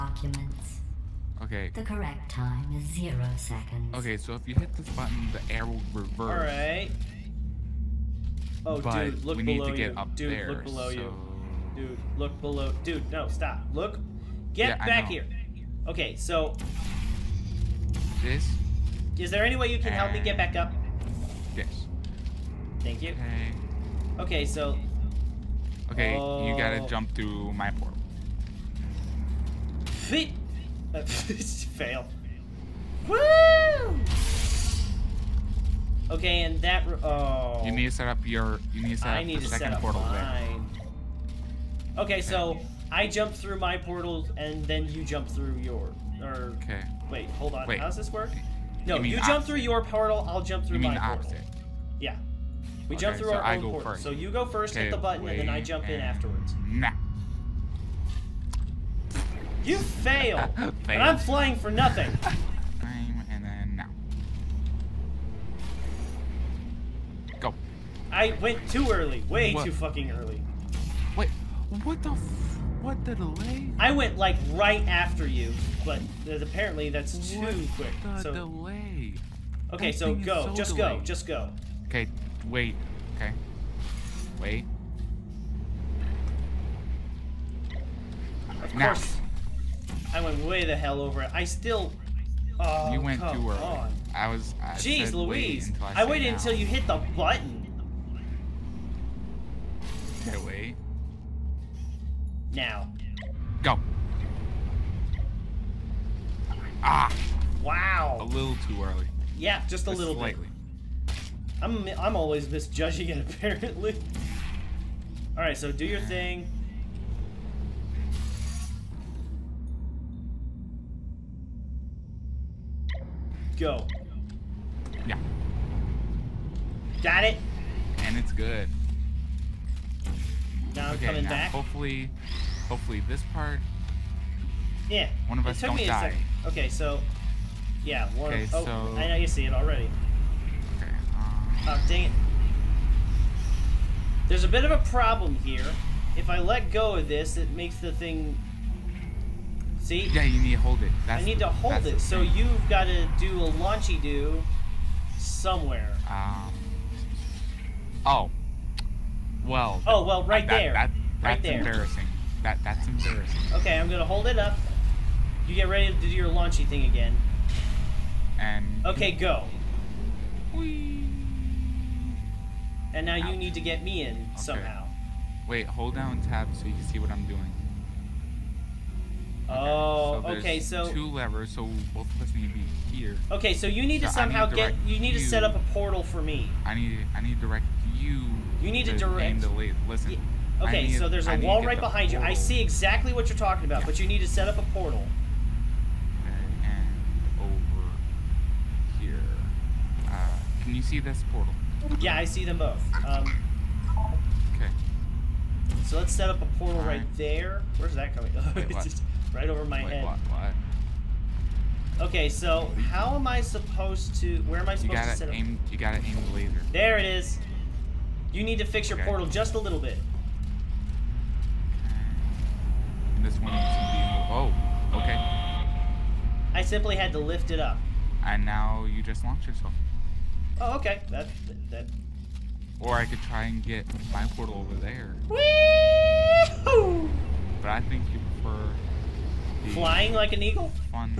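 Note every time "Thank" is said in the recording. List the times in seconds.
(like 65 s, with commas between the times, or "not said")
22 s.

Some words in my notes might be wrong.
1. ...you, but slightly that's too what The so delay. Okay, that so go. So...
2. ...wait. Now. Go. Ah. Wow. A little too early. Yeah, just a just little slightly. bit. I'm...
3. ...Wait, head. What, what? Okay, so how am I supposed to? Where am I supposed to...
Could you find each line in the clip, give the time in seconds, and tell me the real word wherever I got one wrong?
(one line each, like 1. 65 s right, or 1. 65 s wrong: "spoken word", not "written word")
1. 75 s wrong: "apparently", not "slightly"
2. 100 s right
3. 209 s right.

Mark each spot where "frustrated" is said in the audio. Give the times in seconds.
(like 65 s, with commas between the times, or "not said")
not said.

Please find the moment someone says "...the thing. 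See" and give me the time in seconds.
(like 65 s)
147 s.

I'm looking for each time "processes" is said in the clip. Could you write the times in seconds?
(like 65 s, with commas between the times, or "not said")
not said.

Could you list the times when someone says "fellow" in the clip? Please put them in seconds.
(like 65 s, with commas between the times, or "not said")
not said.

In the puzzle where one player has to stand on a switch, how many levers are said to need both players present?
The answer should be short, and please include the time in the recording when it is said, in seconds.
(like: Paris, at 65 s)
2, at 180 s.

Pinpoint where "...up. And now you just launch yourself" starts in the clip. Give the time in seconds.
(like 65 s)
227 s.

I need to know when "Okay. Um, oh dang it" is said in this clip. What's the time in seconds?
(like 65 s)
140 s.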